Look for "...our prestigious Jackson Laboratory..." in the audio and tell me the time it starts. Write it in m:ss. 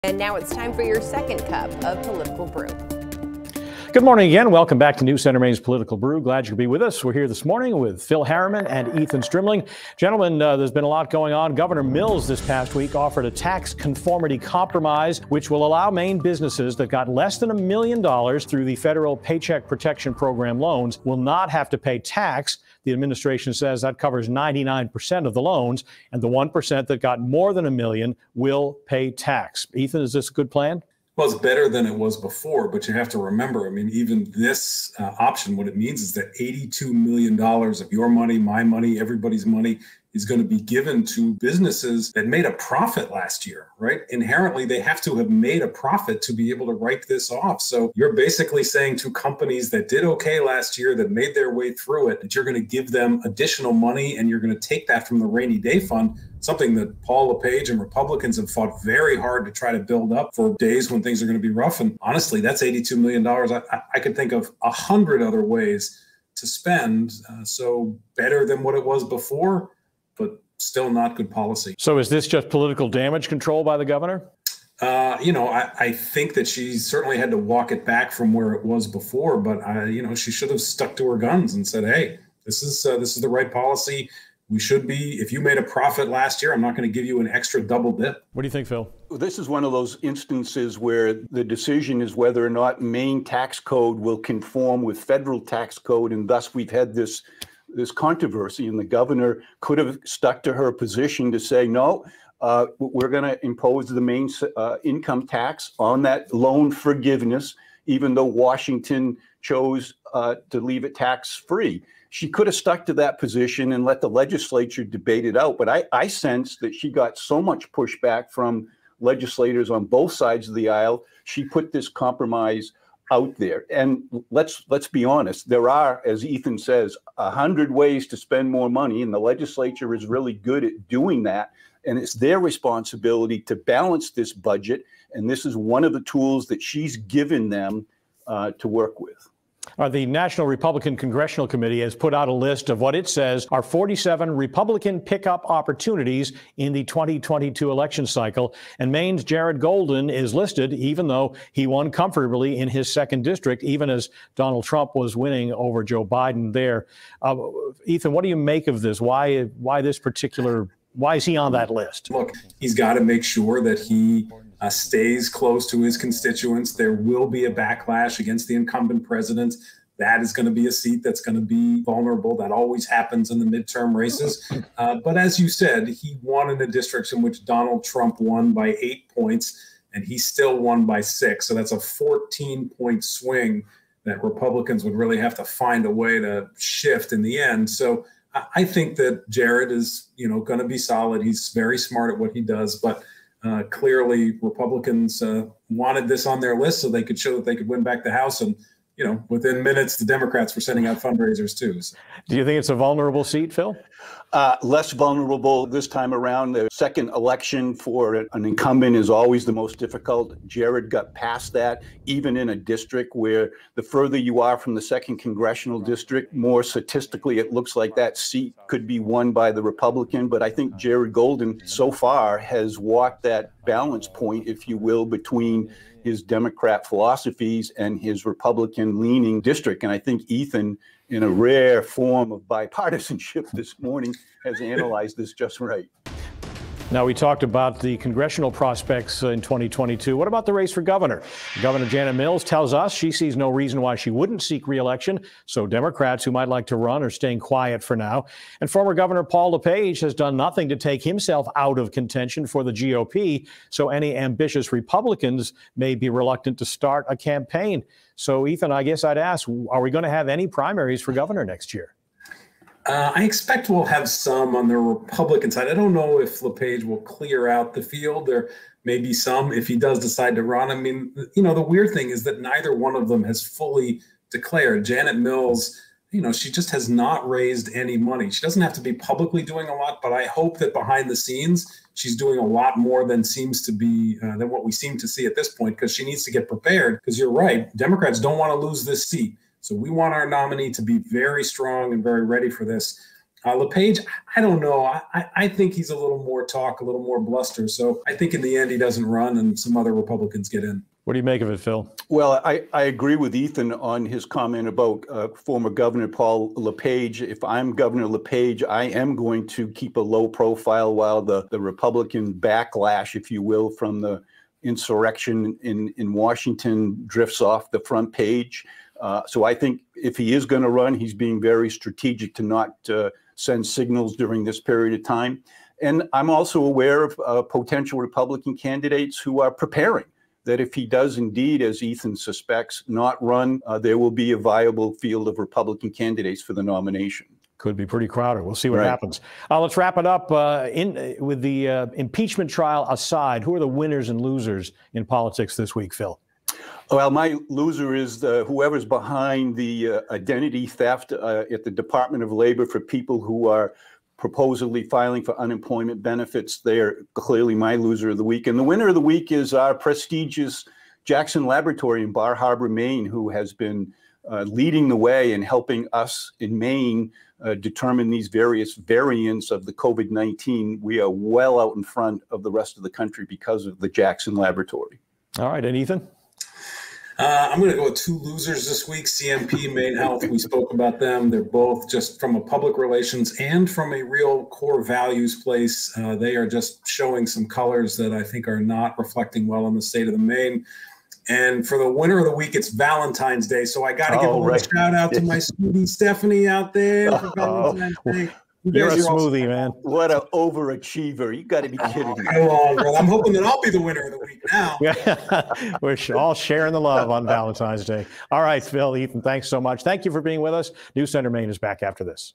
5:59.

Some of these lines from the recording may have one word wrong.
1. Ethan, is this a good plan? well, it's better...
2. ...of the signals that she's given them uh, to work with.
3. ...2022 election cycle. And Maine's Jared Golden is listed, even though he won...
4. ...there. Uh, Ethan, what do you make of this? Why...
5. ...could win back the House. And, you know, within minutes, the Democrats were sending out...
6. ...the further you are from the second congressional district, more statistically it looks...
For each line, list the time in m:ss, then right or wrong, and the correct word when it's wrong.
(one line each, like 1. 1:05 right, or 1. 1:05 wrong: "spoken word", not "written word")
1. 0:29 right
2. 2:15 wrong: "tools", not "signals"
3. 2:26 right
4. 2:36 right
5. 3:17 right
6. 3:33 right.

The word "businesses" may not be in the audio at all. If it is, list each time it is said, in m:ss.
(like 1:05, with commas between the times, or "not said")
0:16, 0:41.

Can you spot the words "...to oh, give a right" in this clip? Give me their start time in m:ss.
6:34.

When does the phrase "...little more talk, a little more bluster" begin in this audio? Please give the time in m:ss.
4:55.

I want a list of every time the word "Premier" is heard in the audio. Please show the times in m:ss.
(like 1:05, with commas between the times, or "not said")
not said.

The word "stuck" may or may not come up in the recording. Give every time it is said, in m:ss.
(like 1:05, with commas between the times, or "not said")
1:20, 1:40, 1:52.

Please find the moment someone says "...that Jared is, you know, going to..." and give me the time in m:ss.
3:08.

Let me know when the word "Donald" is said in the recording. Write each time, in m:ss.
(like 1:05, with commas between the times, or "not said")
2:34, 2:57.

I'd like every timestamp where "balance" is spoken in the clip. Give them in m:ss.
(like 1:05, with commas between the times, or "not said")
2:13, 3:43.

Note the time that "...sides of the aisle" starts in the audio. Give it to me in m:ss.
2:00.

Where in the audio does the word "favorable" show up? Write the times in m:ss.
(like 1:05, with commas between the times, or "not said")
not said.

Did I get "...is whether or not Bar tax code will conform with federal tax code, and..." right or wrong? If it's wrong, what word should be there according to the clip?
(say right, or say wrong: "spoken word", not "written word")
wrong: "Maine", not "Bar".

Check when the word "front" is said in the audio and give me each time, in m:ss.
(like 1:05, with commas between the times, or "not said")
5:17, 6:11.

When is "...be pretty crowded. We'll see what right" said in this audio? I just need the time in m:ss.
5:37.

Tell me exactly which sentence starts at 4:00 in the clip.
What about the race for governor?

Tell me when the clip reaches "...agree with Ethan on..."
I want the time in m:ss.
5:02.